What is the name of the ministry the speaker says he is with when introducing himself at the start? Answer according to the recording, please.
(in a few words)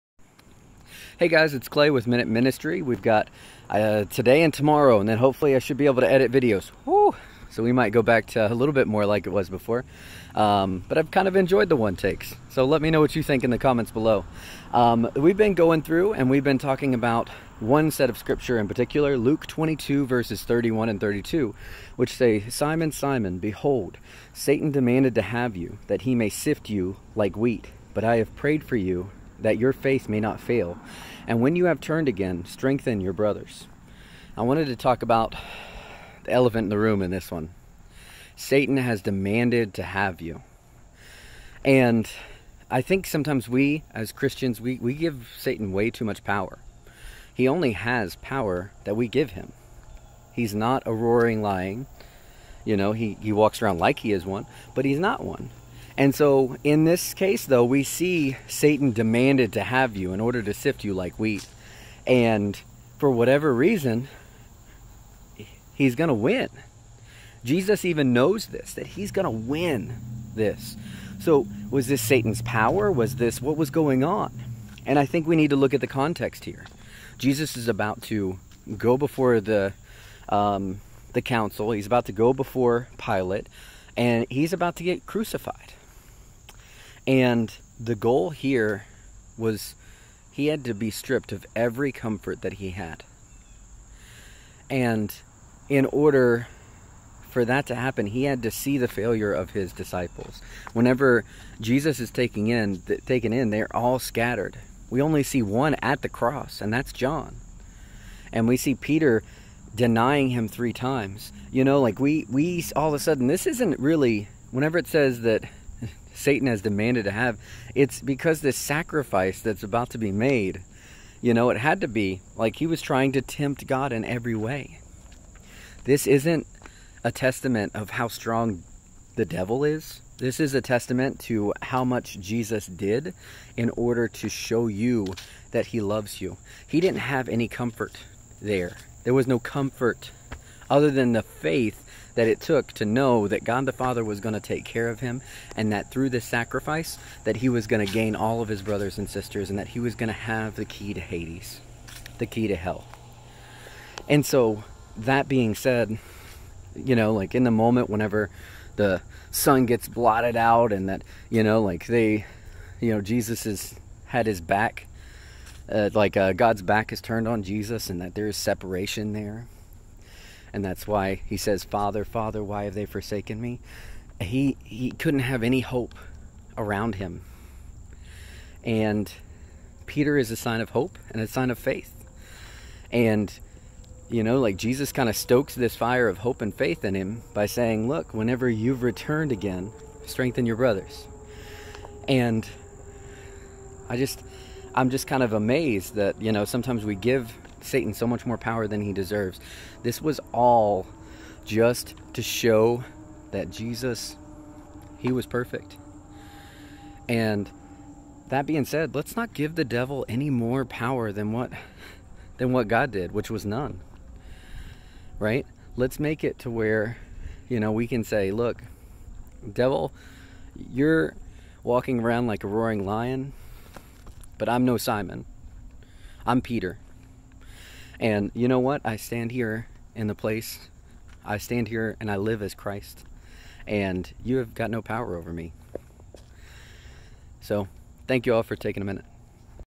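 Minute Ministry.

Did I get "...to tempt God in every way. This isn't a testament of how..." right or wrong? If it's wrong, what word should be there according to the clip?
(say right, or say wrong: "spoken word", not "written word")
right.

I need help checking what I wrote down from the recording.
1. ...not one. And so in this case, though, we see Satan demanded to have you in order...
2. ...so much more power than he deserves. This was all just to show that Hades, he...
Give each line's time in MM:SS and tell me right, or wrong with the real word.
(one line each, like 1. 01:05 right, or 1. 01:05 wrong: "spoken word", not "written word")
1. 00:54 right
2. 03:17 wrong: "Jesus", not "Hades".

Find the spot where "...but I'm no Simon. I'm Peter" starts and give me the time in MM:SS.
03:44.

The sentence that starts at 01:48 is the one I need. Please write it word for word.
And we see Peter denying him three times.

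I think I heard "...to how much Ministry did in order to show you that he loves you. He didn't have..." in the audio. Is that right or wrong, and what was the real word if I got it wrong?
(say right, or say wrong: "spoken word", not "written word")
wrong: "Jesus", not "Ministry".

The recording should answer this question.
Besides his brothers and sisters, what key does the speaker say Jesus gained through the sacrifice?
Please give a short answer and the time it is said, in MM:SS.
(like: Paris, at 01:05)
The key to Hades, at 02:30.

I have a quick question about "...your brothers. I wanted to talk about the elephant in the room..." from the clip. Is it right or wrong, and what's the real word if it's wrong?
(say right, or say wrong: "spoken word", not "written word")
right.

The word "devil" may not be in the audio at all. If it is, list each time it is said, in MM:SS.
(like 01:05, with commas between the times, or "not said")
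02:09, 03:29, 03:39.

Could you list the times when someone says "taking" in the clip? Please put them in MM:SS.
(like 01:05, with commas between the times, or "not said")
01:42, 03:58.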